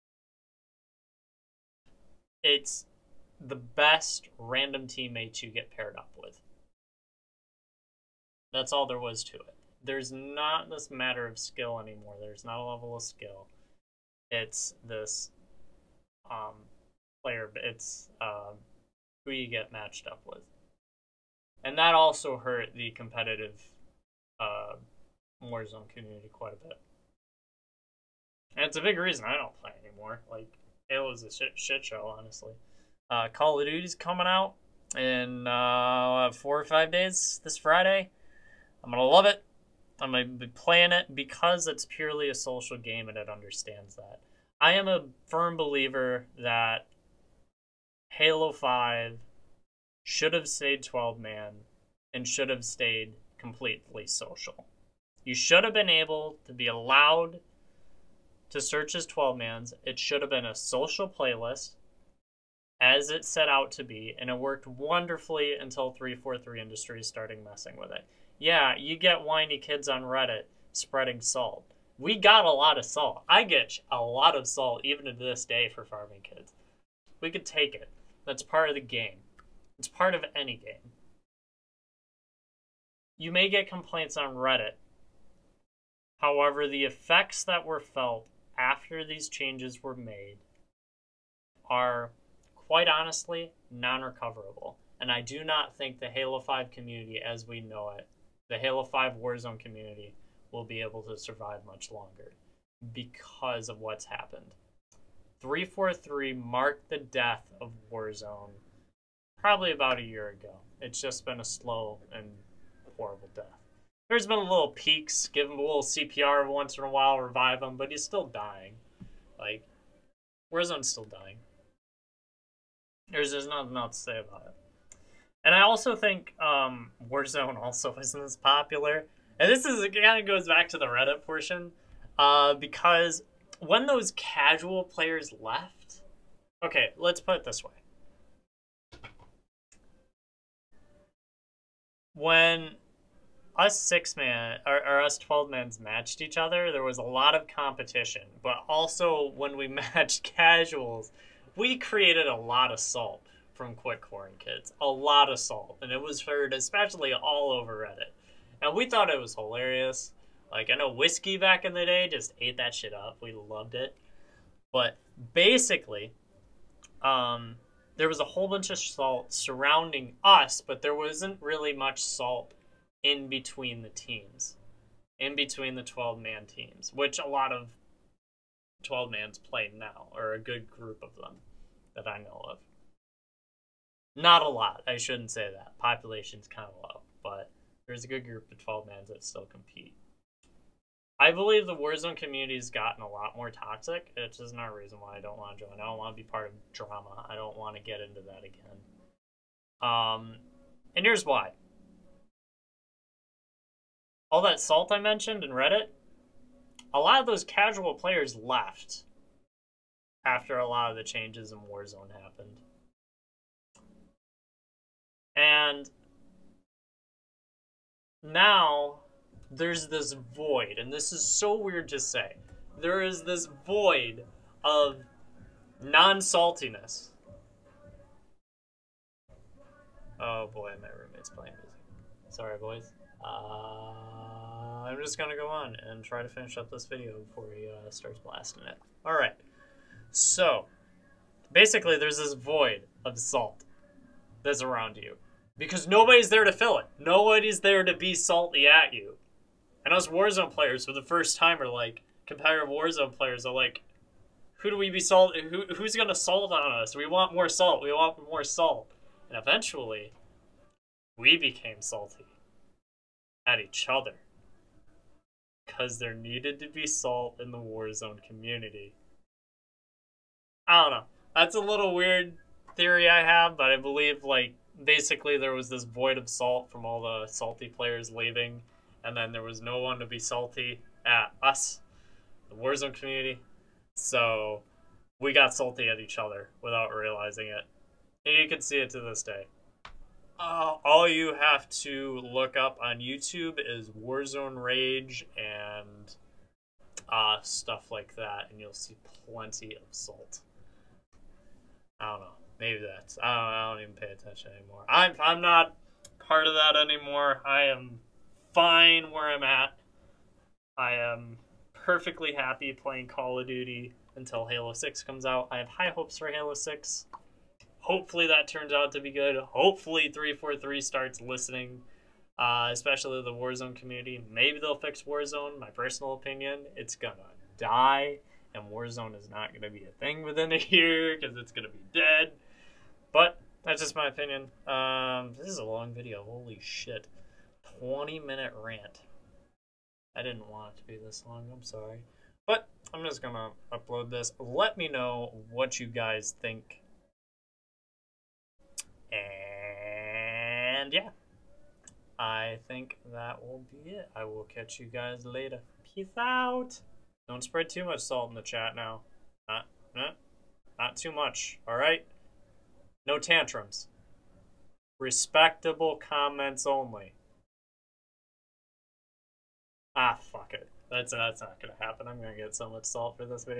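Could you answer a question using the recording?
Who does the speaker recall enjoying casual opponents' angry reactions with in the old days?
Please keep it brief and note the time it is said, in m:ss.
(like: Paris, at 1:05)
Whiskey, at 2:40.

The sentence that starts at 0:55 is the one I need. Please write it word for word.
You should have been able to be allowed to search as 12 mans.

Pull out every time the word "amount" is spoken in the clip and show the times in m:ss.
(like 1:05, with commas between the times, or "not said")
not said.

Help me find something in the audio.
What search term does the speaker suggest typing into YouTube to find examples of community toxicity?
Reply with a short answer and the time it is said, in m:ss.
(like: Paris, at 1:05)
Warzone Rage, at 4:53.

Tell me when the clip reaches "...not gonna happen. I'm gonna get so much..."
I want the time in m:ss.
6:11.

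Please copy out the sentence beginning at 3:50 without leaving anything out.
Oh boy, my roommate's playing music.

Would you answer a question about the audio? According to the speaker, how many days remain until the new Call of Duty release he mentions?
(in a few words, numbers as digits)
4 or 5.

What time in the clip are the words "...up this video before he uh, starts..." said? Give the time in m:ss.
3:56.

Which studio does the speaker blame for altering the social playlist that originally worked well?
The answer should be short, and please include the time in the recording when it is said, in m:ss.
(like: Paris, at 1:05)
343 Industries, at 1:05.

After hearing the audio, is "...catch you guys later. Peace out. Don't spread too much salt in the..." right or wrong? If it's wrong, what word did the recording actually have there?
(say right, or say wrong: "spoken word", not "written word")
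right.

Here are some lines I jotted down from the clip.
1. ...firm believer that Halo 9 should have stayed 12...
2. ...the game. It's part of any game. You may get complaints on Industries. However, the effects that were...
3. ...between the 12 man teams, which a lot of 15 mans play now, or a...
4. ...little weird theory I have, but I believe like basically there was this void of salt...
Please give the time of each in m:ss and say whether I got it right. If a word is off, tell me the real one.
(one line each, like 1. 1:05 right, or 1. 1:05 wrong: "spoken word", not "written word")
1. 0:45 wrong: "5", not "9"
2. 1:18 wrong: "Reddit", not "Industries"
3. 2:55 wrong: "12", not "15"
4. 4:31 right.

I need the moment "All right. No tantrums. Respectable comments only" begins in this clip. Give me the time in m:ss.
6:01.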